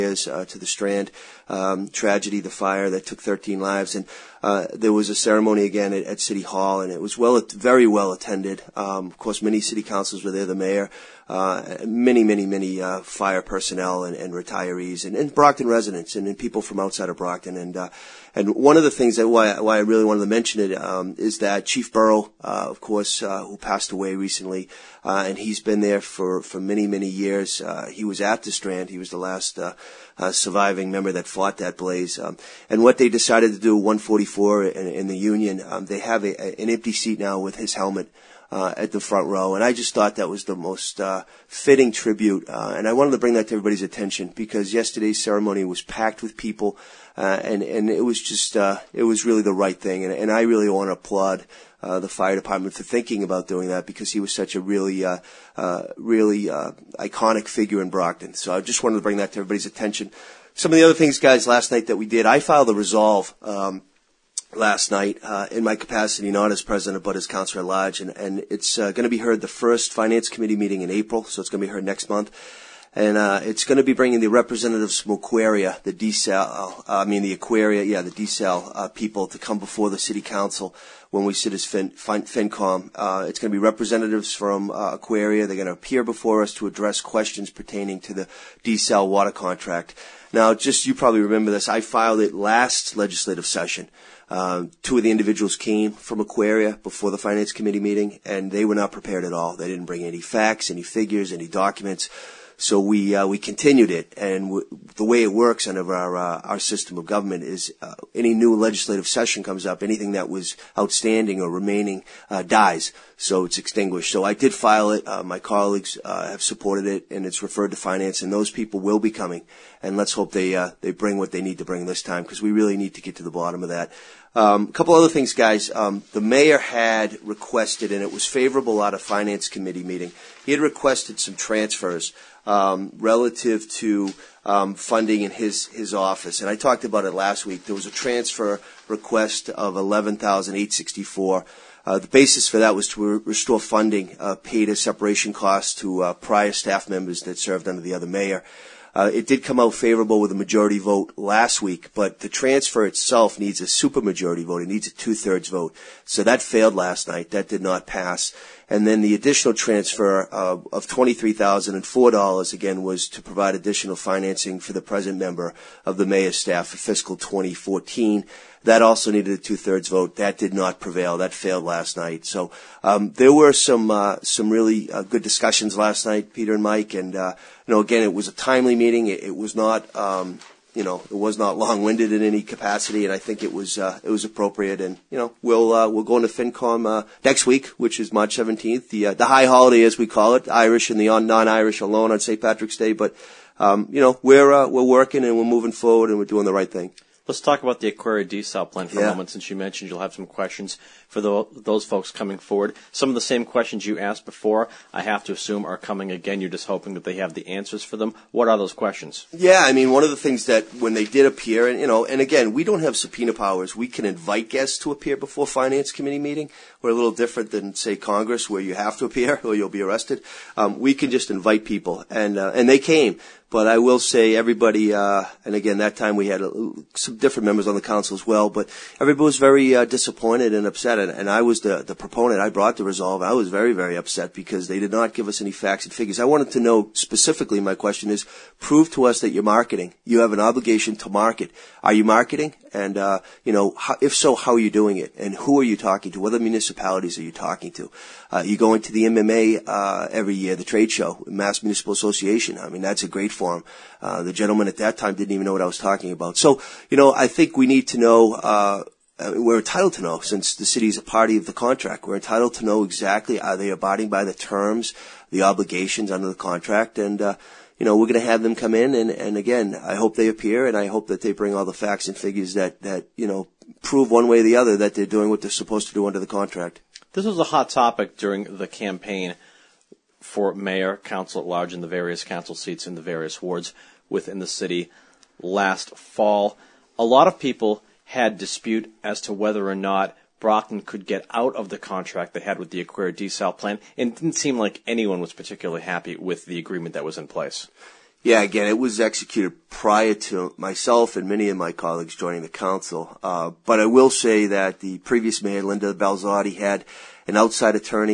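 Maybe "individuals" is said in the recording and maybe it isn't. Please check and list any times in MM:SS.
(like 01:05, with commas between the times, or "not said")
01:35.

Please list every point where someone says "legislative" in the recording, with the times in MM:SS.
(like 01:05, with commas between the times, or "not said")
01:32, 01:48.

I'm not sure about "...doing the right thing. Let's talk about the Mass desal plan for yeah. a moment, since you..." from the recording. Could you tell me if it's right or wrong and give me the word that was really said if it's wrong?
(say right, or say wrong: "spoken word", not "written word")
wrong: "Aquaria", not "Mass".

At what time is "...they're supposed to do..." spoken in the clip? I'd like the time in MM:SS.
04:35.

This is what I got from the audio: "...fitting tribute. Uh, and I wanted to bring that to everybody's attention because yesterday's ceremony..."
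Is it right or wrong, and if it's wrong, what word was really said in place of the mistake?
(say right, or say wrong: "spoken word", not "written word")
right.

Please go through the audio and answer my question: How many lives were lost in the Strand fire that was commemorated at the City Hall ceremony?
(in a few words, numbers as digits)
13.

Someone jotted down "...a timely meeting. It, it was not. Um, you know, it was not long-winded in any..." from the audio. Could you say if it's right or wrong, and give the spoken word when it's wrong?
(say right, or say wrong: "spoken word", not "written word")
right.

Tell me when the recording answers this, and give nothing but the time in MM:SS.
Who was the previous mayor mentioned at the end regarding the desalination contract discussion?
05:05.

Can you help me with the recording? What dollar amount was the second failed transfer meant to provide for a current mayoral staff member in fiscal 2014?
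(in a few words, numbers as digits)
$23,004.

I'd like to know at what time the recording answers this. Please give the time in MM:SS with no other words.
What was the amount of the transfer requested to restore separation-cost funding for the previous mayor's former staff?
02:19.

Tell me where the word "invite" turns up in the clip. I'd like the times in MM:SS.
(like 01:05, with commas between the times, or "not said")
03:34, 03:41.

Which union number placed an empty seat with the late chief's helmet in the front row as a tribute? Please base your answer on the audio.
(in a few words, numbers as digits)
144.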